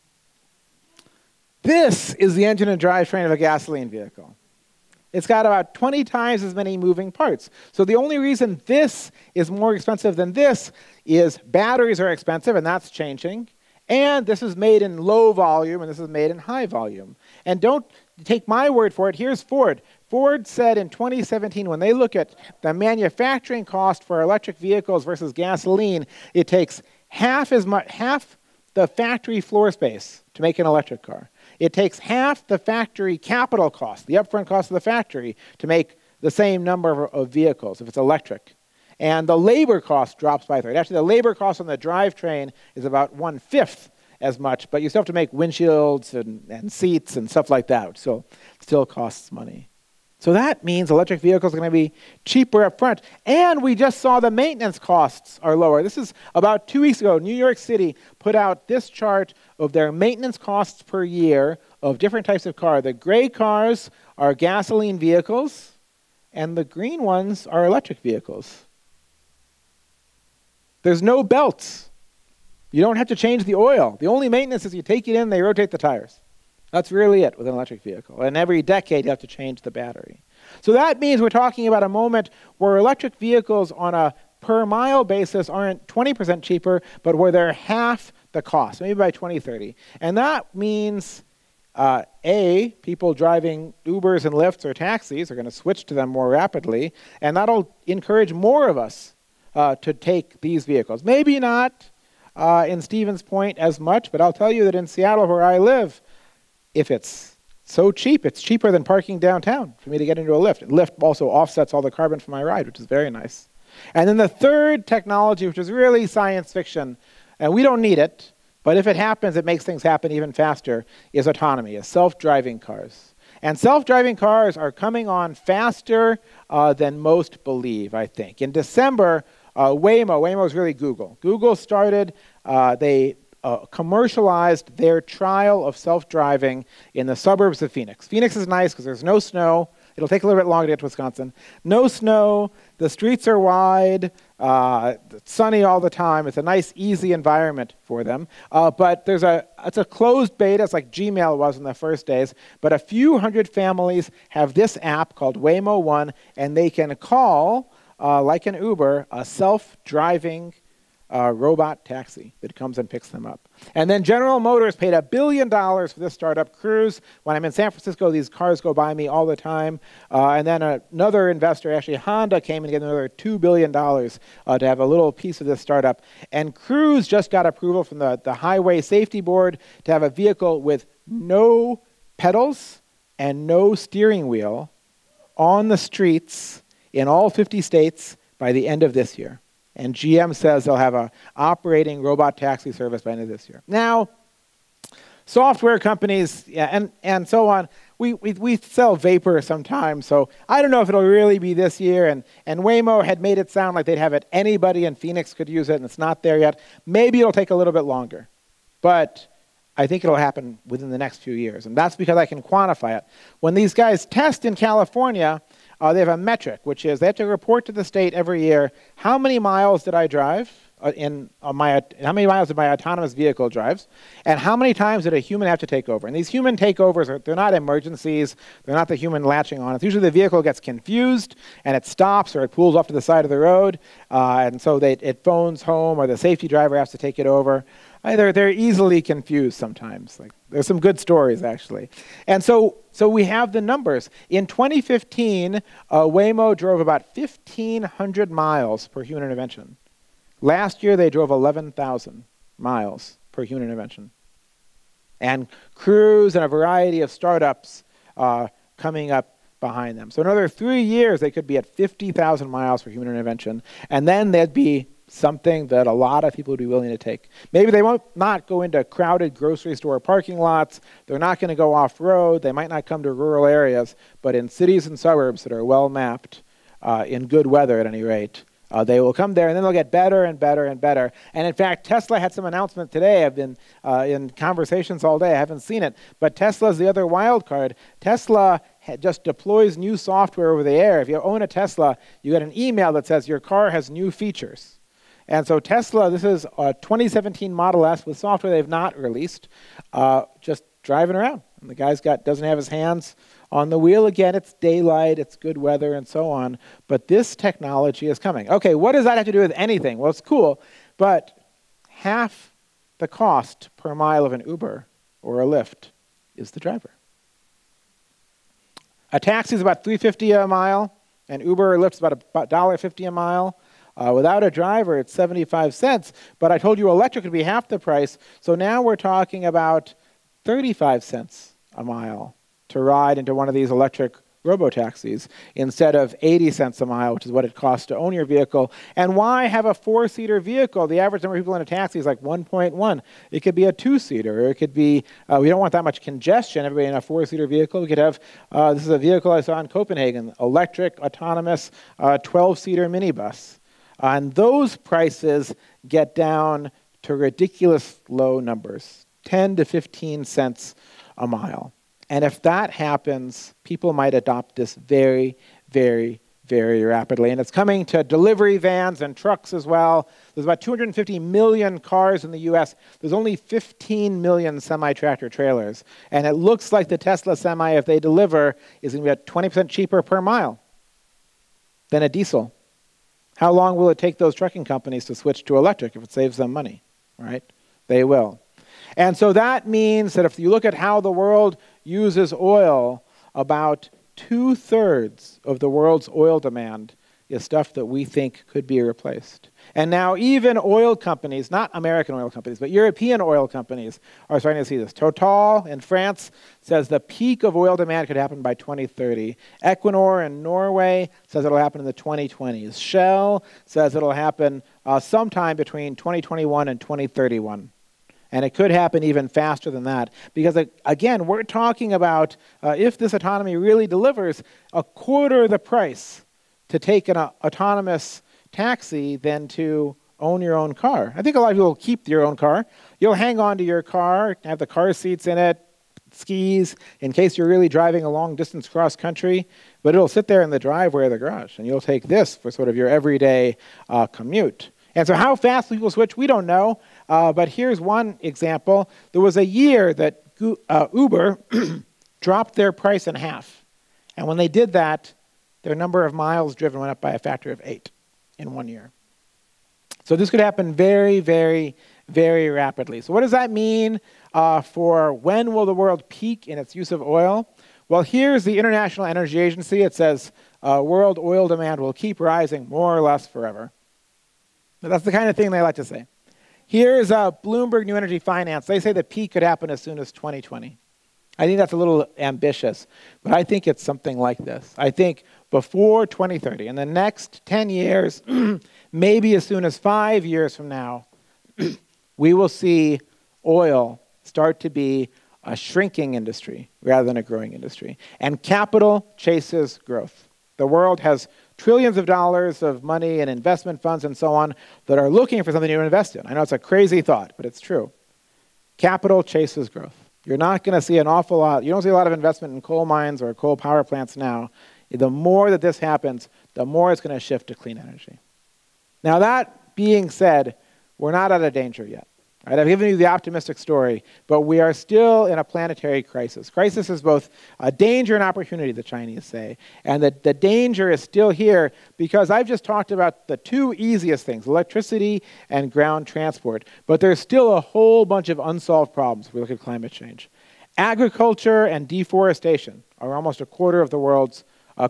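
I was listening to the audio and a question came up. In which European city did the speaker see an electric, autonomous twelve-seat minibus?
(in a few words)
Copenhagen.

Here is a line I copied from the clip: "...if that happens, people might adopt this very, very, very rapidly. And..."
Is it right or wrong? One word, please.
right.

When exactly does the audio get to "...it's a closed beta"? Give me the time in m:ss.
2:29.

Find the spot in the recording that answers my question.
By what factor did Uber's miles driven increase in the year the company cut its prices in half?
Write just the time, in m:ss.
7:37.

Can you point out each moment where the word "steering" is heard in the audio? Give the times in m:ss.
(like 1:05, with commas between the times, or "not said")
3:03.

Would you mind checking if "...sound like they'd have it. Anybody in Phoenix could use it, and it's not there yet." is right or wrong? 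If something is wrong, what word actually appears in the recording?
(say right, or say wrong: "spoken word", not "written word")
right.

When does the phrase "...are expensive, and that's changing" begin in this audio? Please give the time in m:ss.
0:11.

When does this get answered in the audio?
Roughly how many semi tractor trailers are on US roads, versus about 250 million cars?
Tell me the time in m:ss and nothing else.
6:13.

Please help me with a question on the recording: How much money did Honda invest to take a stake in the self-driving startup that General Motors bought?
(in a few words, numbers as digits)
$2 billion.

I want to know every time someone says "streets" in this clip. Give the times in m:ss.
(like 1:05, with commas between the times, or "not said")
2:22, 3:05.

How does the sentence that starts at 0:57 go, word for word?
New York City put out this chart of their maintenance costs per year of different types of car.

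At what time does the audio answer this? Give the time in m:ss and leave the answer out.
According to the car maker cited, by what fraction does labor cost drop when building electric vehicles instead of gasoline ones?
0:40.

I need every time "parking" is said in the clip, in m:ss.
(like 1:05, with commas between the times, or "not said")
1:48, 4:29.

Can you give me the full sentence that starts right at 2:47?
When I'm in San Francisco, these cars go by me all the time.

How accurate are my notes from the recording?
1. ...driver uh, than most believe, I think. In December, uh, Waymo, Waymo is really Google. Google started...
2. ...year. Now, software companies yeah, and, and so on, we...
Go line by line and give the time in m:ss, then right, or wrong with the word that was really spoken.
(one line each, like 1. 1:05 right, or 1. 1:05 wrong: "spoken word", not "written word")
1. 2:05 wrong: "faster", not "driver"
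2. 3:13 right.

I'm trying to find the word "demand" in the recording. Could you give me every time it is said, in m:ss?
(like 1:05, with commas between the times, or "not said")
6:36, 6:47, 7:51.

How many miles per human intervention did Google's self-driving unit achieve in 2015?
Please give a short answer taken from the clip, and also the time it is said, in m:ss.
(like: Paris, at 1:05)
1,500, at 4:07.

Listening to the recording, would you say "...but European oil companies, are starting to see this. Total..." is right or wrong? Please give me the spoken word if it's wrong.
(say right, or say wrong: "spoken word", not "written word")
right.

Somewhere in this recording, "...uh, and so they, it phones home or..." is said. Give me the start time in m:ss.
3:54.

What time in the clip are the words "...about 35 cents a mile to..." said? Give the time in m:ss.
5:29.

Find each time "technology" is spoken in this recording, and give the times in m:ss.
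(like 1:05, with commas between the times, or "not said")
1:54, 5:07.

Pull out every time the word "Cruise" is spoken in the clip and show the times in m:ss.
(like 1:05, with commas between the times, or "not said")
2:46, 2:56, 4:15.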